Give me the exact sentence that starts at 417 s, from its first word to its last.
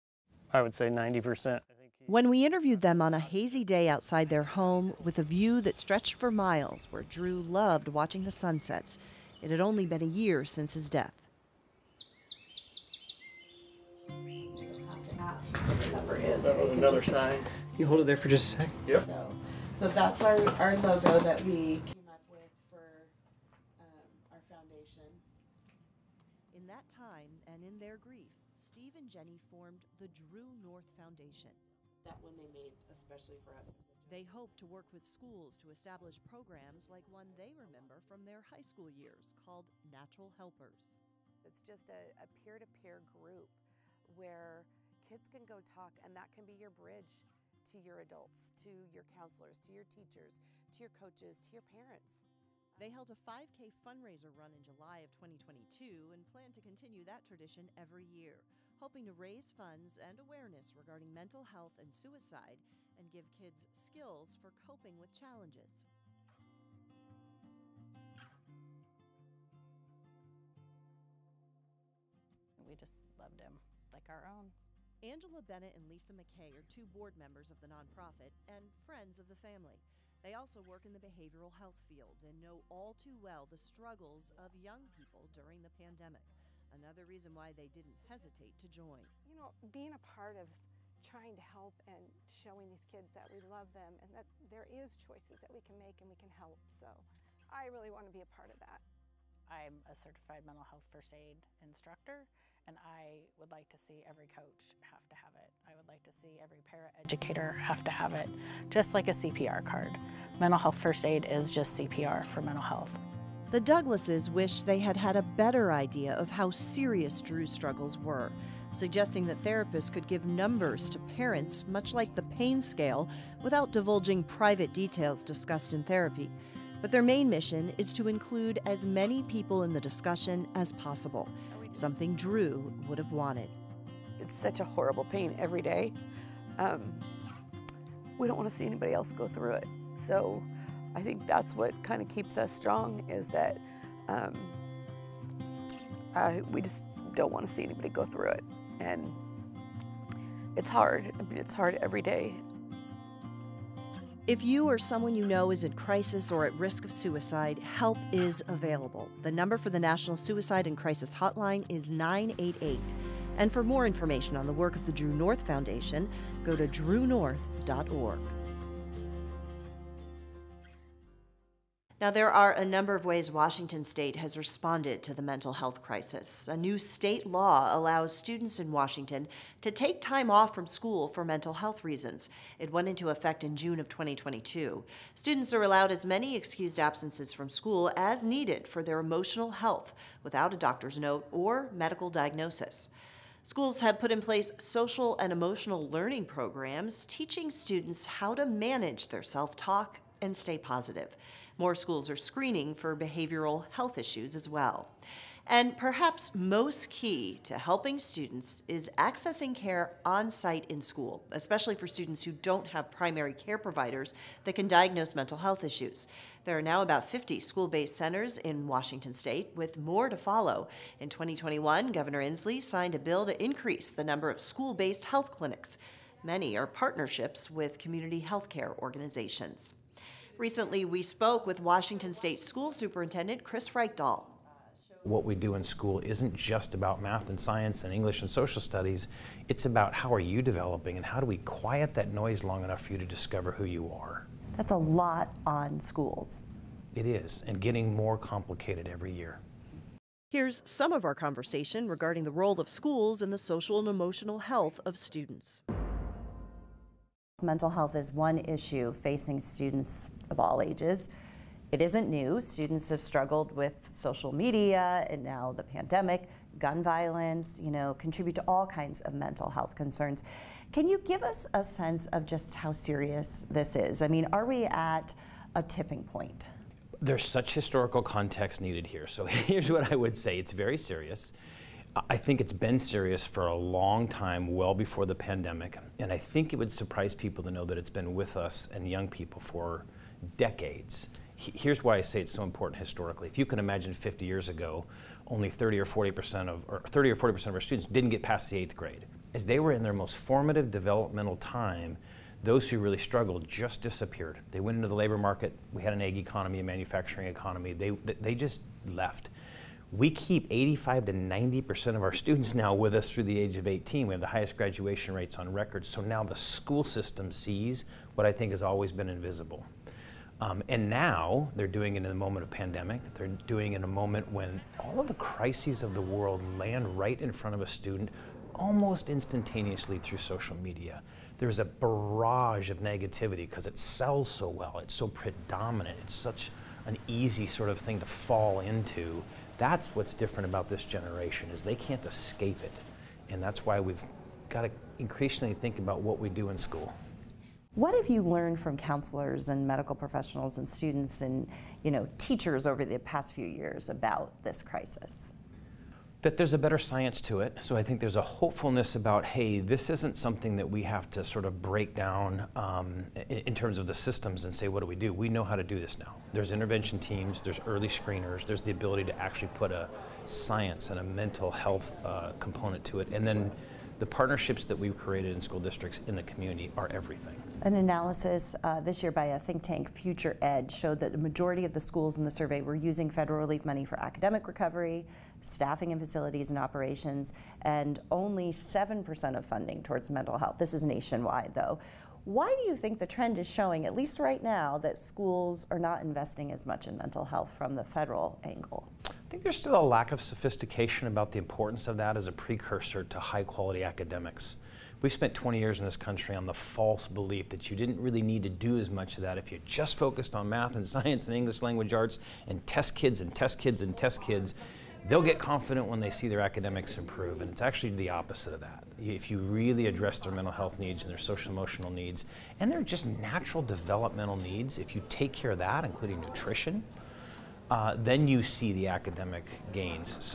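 And it's actually the opposite of that.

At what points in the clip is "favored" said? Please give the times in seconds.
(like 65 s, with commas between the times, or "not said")
not said.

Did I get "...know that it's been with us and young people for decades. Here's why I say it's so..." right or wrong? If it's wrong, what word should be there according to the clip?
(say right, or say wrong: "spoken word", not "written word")
right.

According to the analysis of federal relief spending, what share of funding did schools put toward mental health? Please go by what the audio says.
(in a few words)
7%.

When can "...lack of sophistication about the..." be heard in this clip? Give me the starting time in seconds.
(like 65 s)
399 s.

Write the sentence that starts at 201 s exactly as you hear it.
More schools are screening for behavioral health issues as well.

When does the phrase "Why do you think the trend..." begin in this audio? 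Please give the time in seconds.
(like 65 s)
392 s.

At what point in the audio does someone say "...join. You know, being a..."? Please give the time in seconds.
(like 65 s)
88 s.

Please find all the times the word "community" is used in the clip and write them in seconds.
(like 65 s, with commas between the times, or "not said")
227 s, 376 s.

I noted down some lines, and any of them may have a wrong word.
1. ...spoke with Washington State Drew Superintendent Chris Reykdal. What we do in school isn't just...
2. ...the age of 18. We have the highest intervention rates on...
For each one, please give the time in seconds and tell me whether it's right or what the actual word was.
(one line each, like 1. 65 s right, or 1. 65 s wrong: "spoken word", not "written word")
1. 231 s wrong: "School", not "Drew"
2. 313 s wrong: "graduation", not "intervention".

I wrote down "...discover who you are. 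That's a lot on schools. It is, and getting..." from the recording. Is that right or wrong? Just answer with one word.
right.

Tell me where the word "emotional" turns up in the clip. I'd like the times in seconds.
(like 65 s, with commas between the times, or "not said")
188 s, 195 s, 253 s, 421 s.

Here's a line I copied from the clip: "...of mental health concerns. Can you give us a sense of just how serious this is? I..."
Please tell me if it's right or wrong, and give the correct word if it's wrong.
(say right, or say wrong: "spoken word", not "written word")
right.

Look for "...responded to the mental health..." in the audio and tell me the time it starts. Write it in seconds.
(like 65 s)
174 s.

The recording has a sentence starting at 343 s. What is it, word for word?
And that's why we've got to increasingly think about what we do in school.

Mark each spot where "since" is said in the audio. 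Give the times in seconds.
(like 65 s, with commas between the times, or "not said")
10 s.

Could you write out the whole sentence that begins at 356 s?
that there's a better science to it.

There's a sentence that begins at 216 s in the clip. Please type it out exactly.
There are now about 50 school based centers in Washington state, with more to follow.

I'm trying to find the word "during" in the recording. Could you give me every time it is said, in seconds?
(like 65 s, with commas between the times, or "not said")
85 s.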